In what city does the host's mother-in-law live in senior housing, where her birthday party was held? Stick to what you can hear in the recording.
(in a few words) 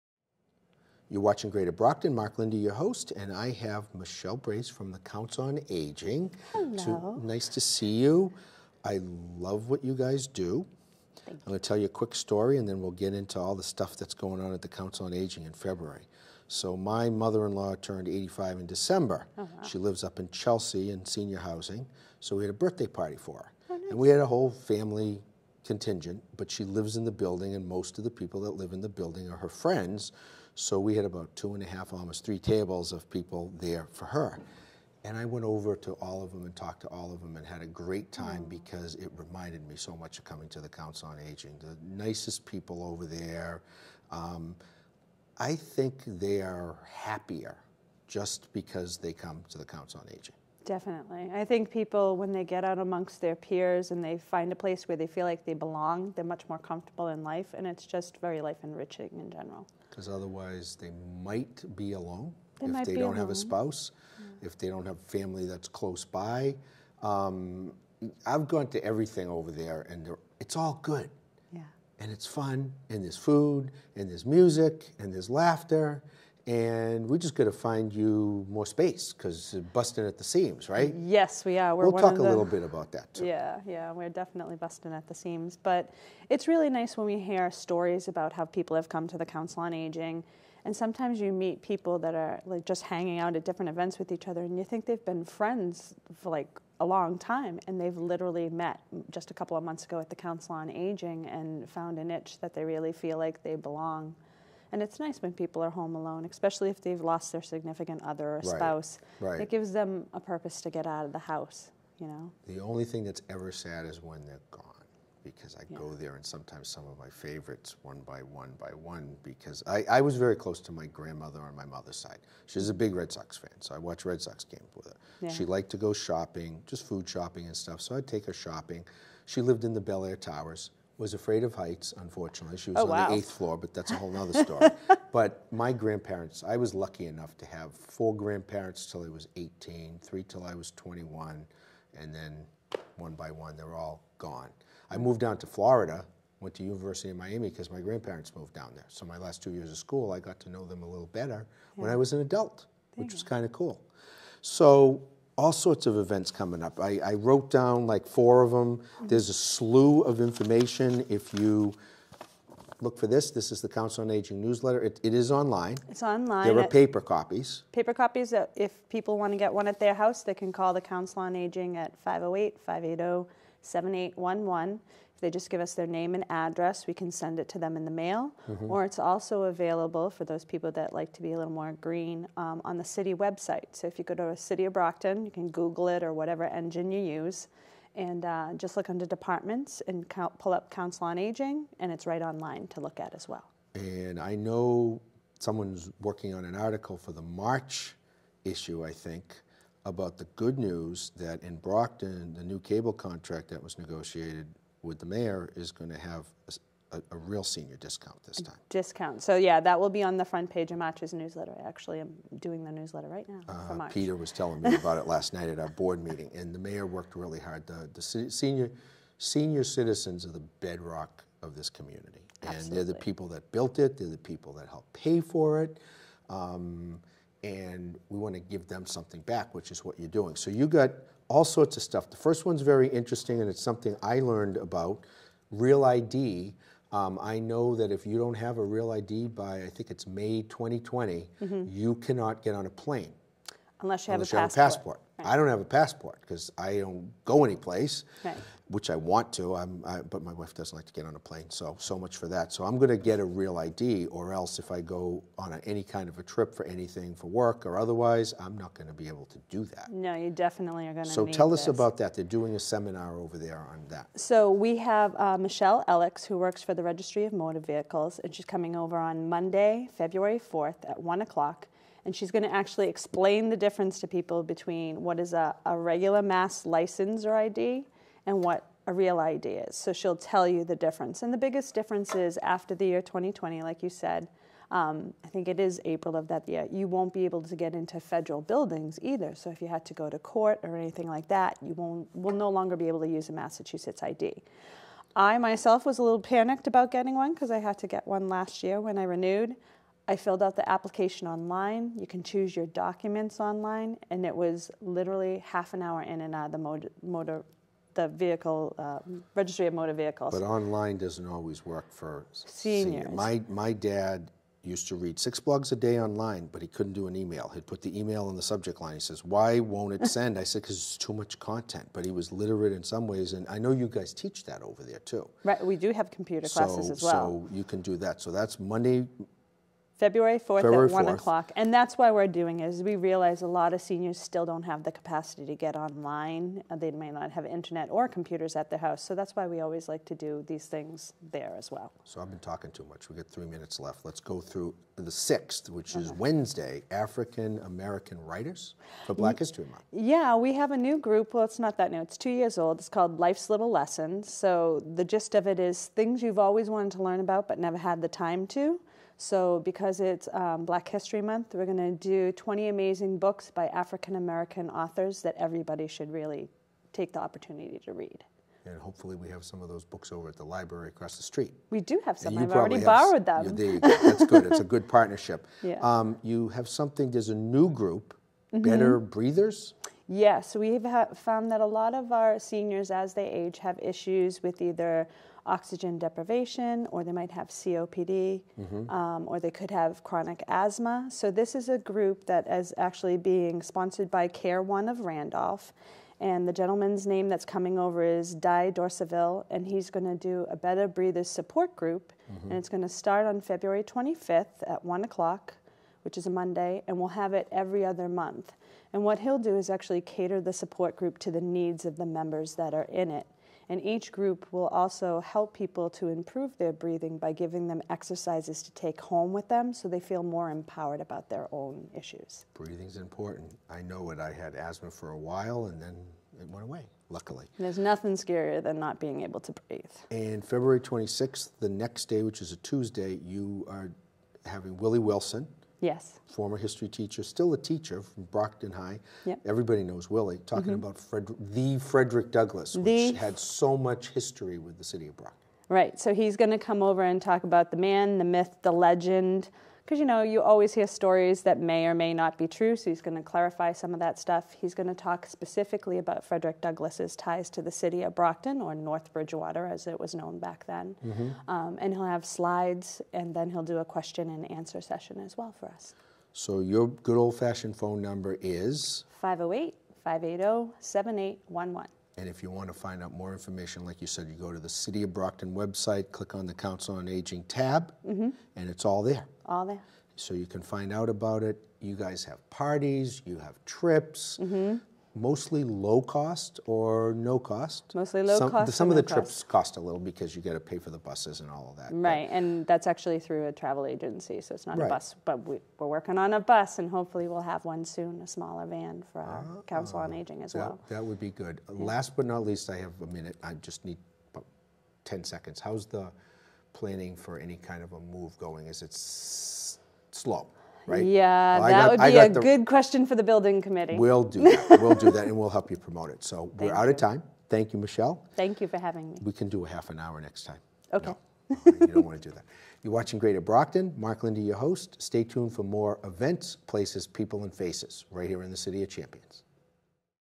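Chelsea.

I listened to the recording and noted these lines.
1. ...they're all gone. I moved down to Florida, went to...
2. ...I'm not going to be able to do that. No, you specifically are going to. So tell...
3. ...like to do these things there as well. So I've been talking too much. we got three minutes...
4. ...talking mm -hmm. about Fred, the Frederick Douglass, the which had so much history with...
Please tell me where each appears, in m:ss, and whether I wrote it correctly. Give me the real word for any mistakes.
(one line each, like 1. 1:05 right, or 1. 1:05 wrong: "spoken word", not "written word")
1. 2:23 right
2. 4:18 wrong: "definitely", not "specifically"
3. 5:39 right
4. 7:20 right.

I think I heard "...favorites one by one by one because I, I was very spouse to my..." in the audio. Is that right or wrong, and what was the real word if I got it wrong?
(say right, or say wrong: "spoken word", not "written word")
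wrong: "close", not "spouse".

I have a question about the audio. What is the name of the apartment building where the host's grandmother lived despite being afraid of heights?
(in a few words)
Bel Air Towers.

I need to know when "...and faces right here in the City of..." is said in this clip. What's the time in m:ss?
8:47.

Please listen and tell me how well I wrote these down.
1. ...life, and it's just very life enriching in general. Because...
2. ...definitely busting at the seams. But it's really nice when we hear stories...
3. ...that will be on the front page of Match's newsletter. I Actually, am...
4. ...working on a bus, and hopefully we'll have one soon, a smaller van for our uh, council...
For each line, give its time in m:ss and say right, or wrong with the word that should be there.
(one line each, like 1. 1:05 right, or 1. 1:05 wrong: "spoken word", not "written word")
1. 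0:57 right
2. 1:24 right
3. 3:29 right
4. 8:15 right.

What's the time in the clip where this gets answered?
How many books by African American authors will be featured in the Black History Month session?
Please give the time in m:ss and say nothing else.
6:02.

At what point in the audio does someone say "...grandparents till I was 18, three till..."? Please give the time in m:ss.
2:18.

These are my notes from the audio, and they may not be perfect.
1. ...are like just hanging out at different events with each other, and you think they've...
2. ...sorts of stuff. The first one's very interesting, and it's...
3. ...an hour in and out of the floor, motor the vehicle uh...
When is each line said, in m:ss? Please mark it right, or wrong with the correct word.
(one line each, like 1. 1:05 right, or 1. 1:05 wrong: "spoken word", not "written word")
1. 1:32 right
2. 3:51 right
3. 5:05 wrong: "motor", not "floor".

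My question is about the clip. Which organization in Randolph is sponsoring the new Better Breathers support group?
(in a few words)
Care One.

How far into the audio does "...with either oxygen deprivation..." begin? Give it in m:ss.
6:24.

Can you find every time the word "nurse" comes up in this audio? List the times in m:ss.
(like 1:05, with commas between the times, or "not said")
not said.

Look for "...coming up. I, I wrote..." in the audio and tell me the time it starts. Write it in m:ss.
2:36.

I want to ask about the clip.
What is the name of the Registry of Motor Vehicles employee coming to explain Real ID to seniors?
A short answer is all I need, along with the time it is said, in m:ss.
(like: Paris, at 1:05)
Michelle Elix, at 4:25.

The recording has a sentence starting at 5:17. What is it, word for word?
He'd put the email in the subject line.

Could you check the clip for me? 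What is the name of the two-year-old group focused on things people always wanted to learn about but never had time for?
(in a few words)
Life's Little Lessons.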